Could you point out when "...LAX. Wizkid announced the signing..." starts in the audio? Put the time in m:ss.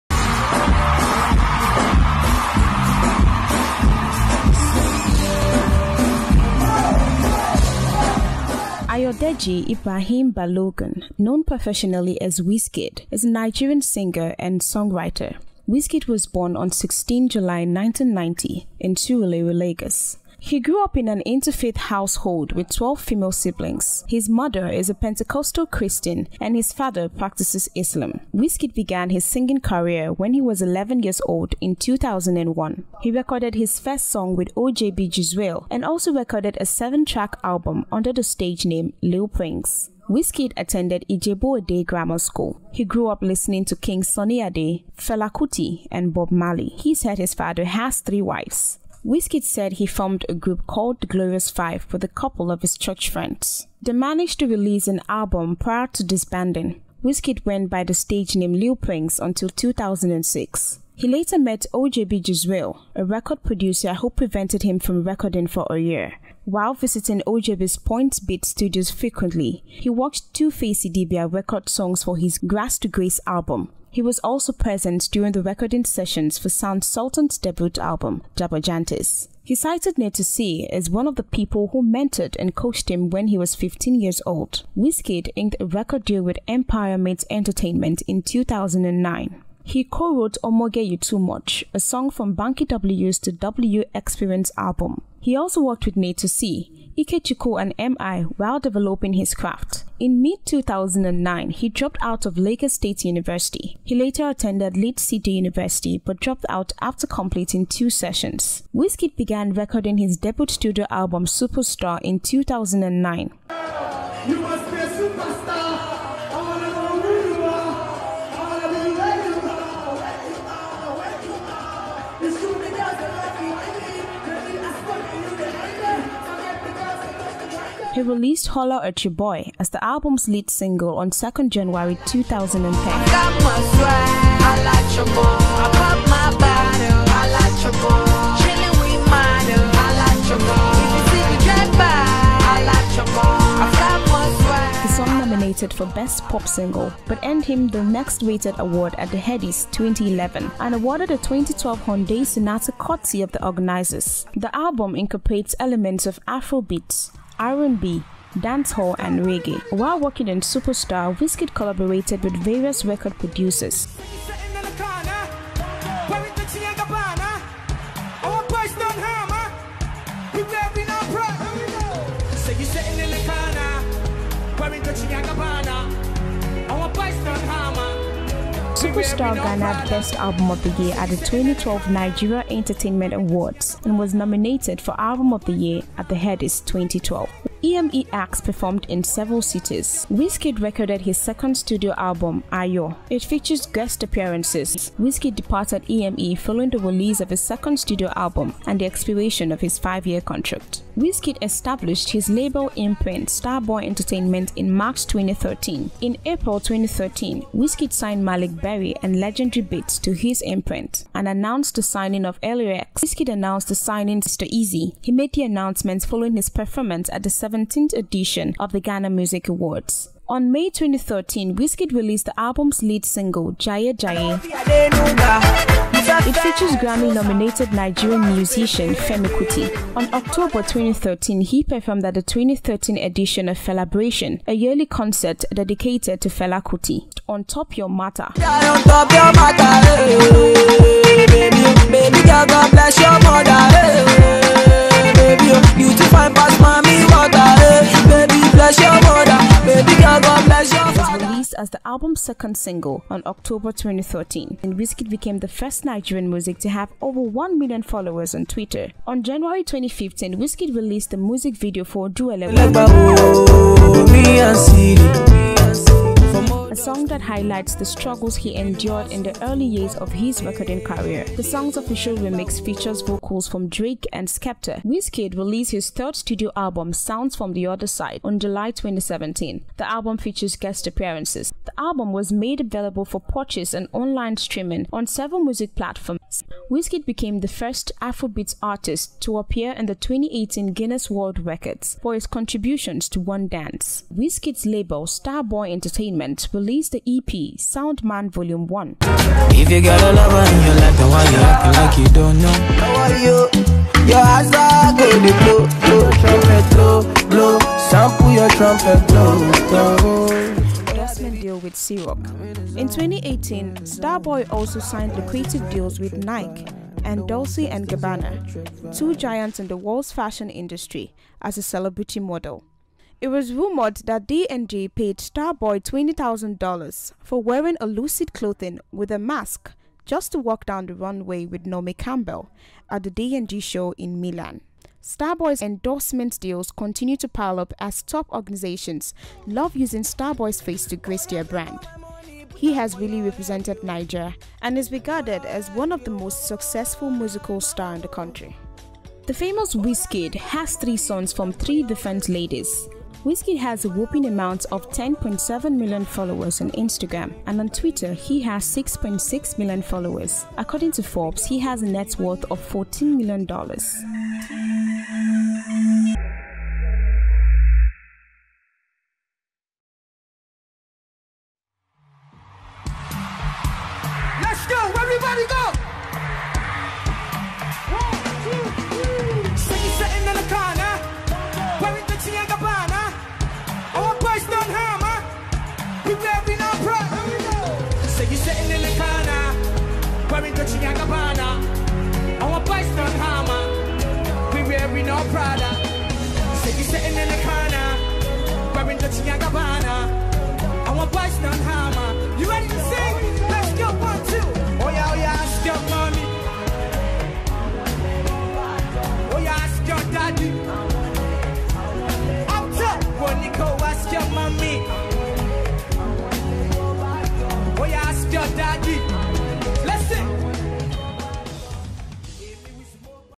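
3:32.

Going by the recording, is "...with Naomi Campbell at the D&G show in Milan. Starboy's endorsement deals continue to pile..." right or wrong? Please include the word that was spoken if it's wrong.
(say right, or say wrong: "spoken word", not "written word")
right.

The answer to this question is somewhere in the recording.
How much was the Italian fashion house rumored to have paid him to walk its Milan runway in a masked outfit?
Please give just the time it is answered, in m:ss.
5:25.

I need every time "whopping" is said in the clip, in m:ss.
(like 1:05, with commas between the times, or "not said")
5:53.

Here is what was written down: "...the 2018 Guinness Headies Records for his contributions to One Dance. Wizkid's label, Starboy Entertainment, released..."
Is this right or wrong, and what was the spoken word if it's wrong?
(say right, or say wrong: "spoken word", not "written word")
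wrong: "World", not "Headies".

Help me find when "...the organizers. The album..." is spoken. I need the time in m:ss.
2:33.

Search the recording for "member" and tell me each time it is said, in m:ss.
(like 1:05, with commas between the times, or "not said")
not said.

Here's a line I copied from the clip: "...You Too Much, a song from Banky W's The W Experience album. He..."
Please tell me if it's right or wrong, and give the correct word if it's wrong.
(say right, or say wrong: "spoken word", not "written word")
right.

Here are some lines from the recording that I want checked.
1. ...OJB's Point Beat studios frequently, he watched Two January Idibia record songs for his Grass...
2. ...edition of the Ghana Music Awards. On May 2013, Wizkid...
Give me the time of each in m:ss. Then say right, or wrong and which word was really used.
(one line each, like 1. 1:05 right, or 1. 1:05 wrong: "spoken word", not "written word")
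1. 1:07 wrong: "Face", not "January"
2. 3:37 right.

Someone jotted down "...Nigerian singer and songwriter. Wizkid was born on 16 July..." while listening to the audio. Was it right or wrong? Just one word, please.
right.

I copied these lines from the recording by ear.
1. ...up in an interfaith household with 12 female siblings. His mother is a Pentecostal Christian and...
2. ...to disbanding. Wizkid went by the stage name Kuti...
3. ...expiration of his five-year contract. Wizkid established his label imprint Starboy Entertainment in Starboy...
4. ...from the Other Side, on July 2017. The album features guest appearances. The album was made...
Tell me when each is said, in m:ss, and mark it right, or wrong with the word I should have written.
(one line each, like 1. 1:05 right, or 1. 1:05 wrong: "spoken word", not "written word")
1. 0:20 right
2. 0:55 wrong: "Lil", not "Kuti"
3. 3:18 wrong: "March", not "Starboy"
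4. 4:37 right.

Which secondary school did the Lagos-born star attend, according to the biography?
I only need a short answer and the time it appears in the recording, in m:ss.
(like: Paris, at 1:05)
Ijebu Ade Grammar School, at 0:41.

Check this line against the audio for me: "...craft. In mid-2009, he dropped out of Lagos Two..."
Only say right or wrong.
wrong.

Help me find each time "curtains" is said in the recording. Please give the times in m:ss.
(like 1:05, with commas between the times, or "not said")
not said.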